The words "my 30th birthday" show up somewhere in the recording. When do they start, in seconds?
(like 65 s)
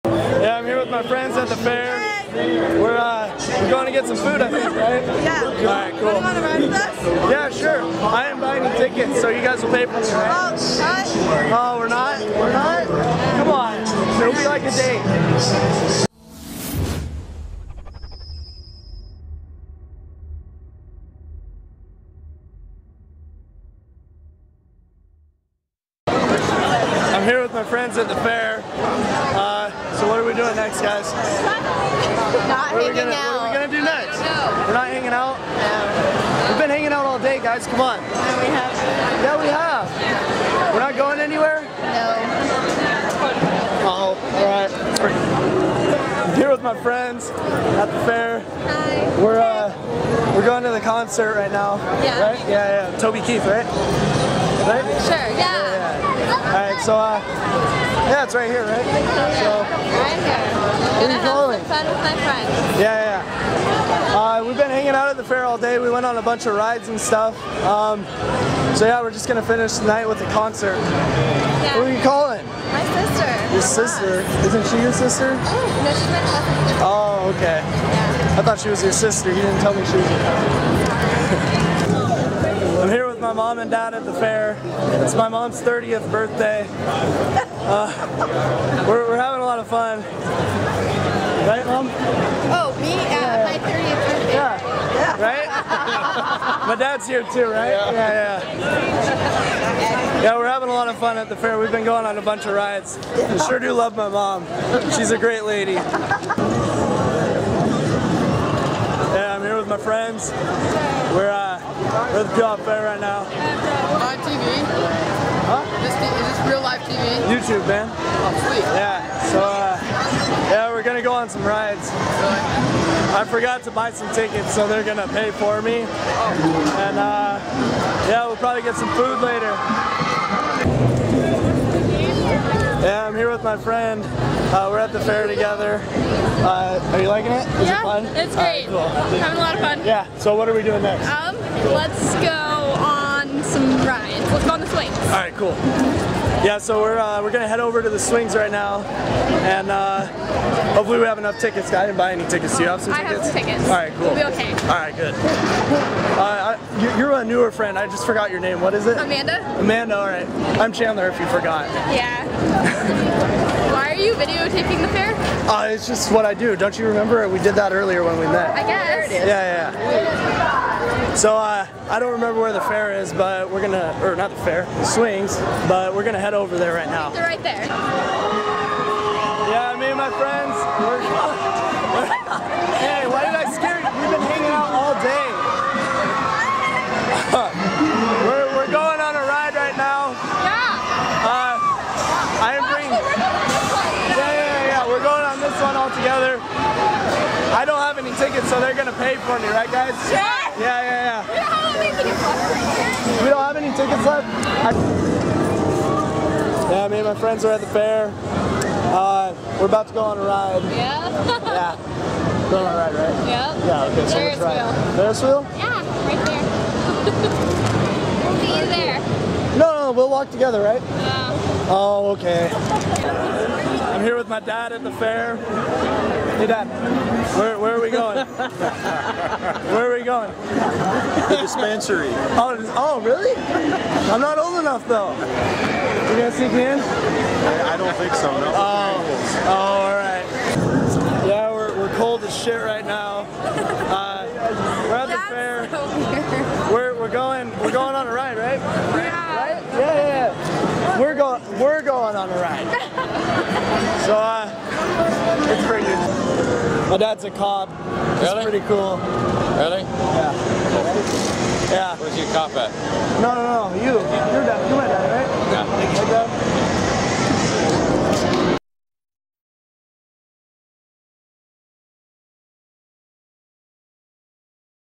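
93 s.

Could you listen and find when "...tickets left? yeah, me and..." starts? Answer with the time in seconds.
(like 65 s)
204 s.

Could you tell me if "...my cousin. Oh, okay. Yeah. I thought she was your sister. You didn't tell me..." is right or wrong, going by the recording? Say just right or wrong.
right.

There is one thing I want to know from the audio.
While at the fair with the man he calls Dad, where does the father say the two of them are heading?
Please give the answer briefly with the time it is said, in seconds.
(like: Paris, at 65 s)
The dispensary, at 231 s.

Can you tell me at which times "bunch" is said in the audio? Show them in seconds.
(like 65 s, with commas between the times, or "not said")
66 s, 102 s.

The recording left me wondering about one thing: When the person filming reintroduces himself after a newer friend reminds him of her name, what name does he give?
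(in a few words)
Chandler.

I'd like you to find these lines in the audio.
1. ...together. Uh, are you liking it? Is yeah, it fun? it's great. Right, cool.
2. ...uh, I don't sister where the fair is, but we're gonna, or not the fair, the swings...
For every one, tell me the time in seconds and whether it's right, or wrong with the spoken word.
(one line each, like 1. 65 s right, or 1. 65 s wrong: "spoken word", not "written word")
1. 135 s right
2. 171 s wrong: "remember", not "sister".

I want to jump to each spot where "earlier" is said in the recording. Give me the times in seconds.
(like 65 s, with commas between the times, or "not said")
167 s.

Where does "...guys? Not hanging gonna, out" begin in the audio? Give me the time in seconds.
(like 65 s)
30 s.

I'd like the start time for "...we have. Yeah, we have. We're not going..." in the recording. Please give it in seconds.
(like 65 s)
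38 s.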